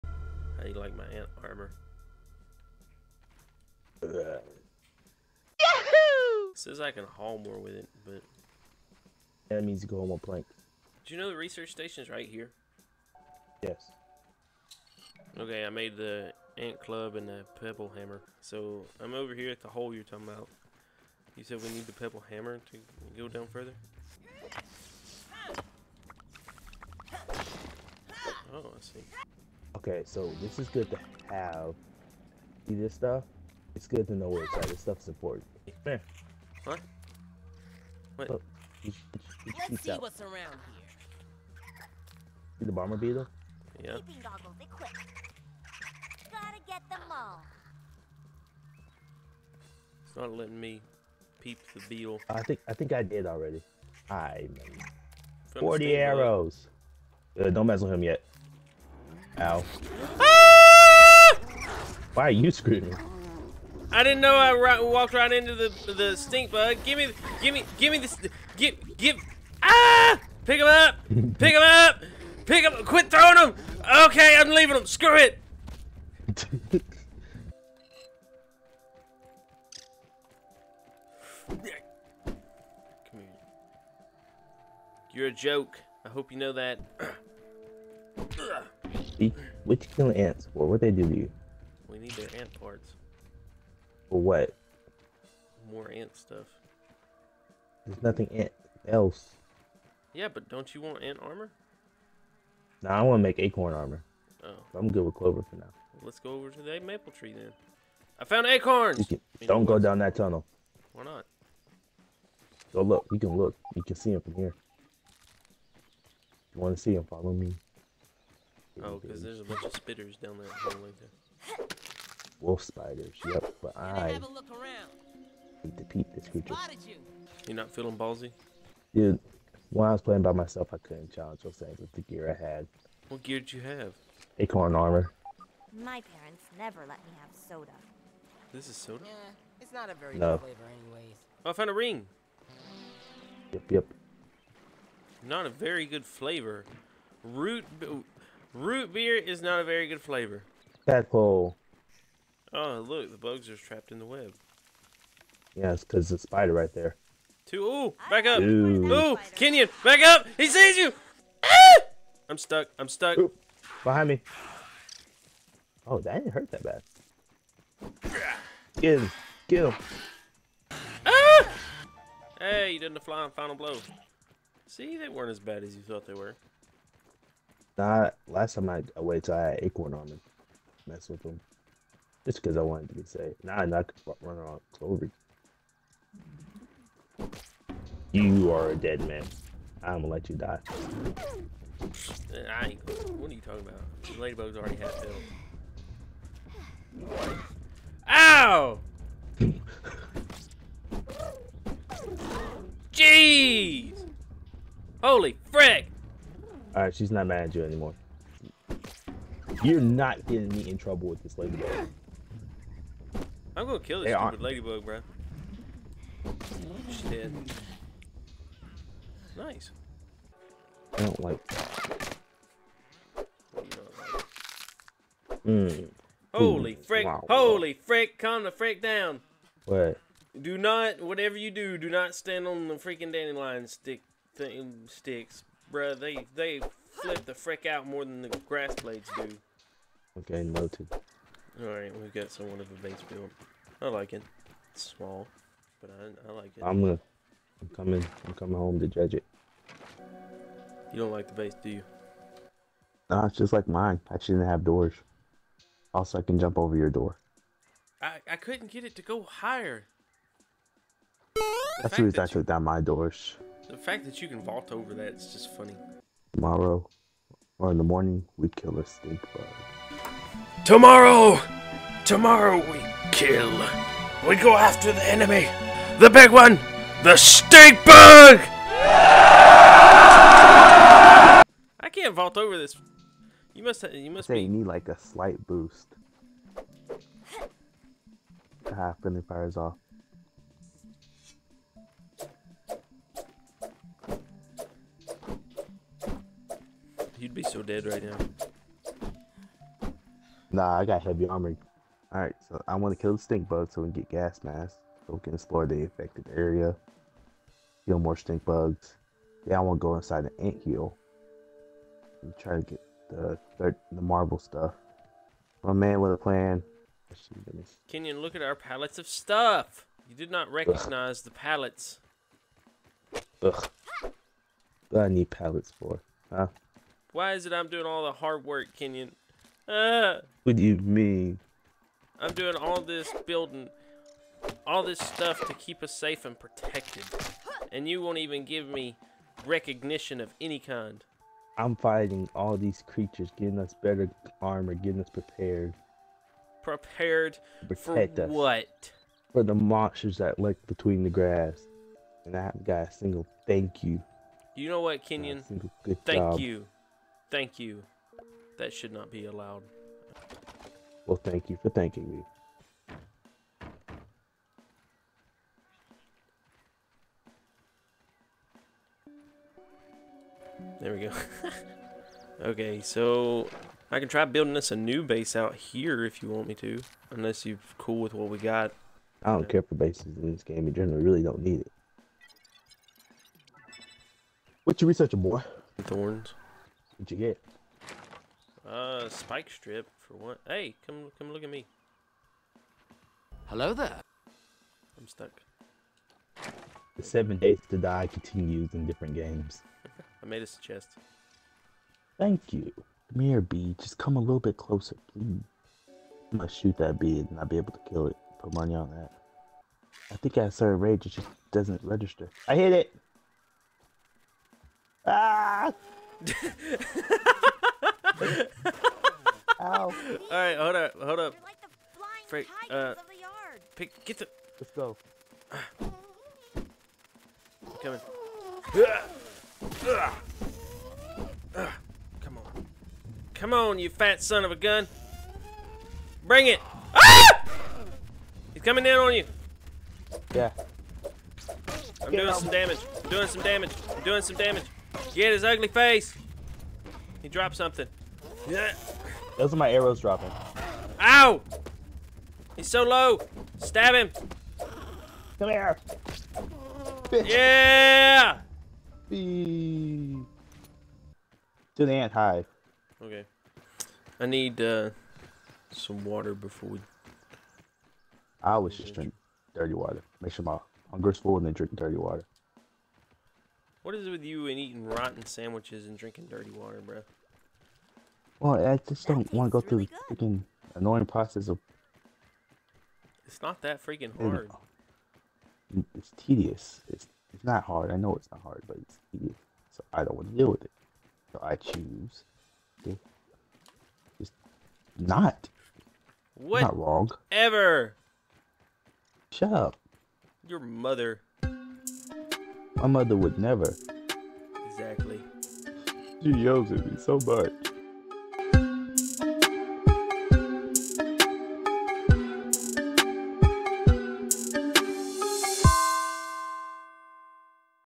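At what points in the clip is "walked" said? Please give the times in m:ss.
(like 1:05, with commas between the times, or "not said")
1:04.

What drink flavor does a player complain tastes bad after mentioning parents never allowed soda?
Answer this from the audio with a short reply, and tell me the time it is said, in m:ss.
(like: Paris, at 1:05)
Root beer, at 2:28.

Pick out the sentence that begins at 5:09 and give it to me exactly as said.
Yeah, I want to go inside the ant hill.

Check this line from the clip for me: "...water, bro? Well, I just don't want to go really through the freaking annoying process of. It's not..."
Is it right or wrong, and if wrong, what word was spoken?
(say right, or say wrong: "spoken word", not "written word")
right.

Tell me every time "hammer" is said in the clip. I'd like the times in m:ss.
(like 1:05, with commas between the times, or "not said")
0:17, 0:22.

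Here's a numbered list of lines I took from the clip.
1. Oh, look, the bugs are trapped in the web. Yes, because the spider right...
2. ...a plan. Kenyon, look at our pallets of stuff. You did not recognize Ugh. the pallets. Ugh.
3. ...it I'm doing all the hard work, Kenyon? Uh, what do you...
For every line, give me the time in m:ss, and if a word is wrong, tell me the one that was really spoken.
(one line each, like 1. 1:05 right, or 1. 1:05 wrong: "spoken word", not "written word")
1. 2:32 right
2. 5:16 right
3. 5:27 right.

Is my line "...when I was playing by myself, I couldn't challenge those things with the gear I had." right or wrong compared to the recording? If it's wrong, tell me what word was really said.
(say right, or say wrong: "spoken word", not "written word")
right.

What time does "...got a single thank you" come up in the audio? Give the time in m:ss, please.
5:52.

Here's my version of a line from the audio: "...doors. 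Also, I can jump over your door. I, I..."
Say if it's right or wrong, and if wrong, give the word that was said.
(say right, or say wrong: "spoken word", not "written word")
right.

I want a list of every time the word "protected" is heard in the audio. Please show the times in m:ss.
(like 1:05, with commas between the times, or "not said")
5:36.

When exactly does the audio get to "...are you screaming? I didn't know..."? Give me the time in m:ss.
1:02.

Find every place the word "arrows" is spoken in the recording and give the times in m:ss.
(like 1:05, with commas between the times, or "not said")
0:55, 7:29.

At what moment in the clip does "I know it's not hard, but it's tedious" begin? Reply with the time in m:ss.
8:07.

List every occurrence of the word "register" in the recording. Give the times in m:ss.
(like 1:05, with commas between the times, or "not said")
6:51.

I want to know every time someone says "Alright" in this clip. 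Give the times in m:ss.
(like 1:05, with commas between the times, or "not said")
4:01, 5:02.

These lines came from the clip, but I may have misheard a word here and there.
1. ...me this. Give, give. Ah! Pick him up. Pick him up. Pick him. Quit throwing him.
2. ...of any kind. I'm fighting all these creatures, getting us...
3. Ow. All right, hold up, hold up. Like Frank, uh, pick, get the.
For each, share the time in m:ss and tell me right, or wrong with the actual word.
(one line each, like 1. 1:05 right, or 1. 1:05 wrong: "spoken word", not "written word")
1. 1:07 right
2. 5:40 right
3. 6:56 right.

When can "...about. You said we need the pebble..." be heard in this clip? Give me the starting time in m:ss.
0:20.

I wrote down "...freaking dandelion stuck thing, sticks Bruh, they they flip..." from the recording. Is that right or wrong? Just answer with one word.
wrong.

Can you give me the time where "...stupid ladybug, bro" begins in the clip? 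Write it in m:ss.
3:34.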